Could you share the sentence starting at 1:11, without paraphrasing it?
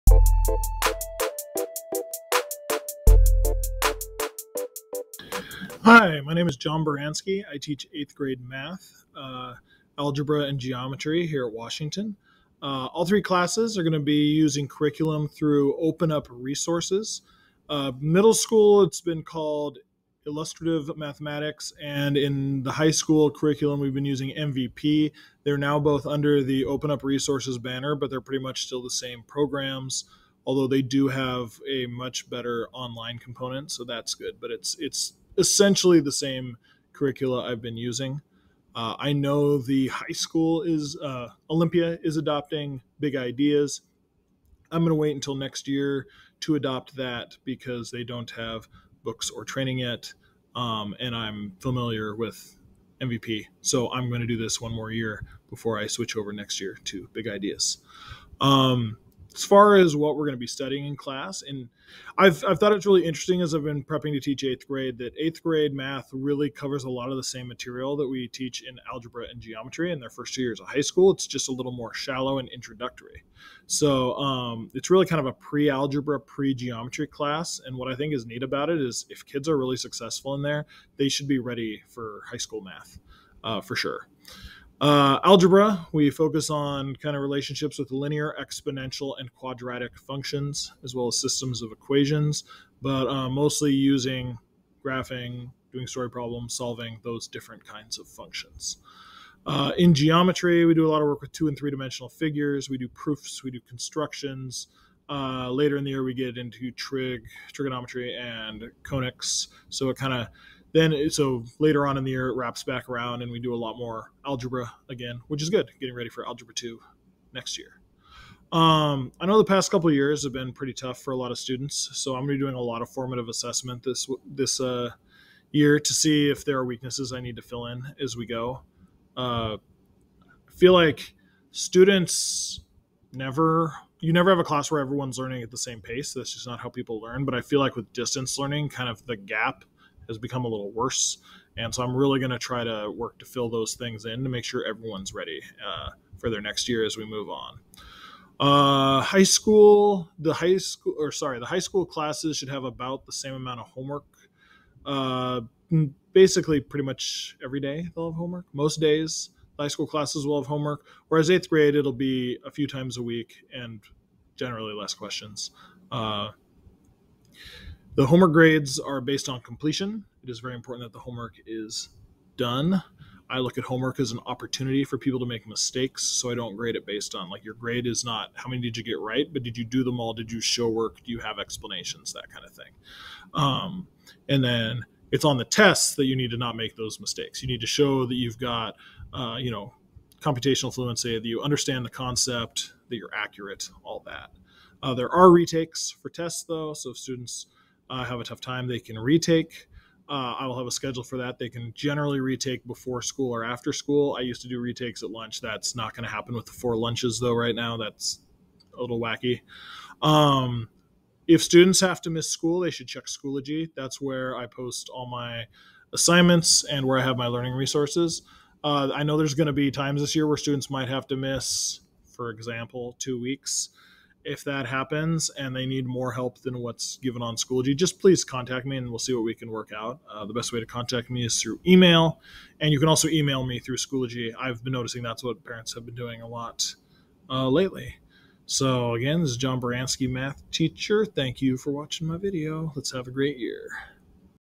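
It's just a little more shallow and introductory.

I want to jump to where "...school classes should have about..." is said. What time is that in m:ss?
2:31.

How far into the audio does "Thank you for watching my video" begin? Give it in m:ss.
4:01.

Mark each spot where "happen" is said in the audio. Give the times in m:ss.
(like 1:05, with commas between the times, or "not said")
3:26, 3:44.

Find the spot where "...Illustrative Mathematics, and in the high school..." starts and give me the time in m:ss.
0:20.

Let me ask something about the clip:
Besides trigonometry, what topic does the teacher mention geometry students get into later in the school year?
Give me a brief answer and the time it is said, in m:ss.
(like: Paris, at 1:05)
Conics, at 1:48.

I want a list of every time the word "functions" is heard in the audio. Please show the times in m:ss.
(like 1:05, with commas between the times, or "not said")
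1:29, 1:38.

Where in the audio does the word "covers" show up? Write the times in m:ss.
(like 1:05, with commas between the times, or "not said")
1:06.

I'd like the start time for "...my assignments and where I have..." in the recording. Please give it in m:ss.
3:35.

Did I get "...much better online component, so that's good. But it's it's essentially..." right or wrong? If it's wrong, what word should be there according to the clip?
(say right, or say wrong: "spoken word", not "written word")
right.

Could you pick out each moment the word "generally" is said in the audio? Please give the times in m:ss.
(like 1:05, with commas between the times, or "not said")
2:44, 3:21.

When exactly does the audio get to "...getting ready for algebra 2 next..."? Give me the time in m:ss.
1:55.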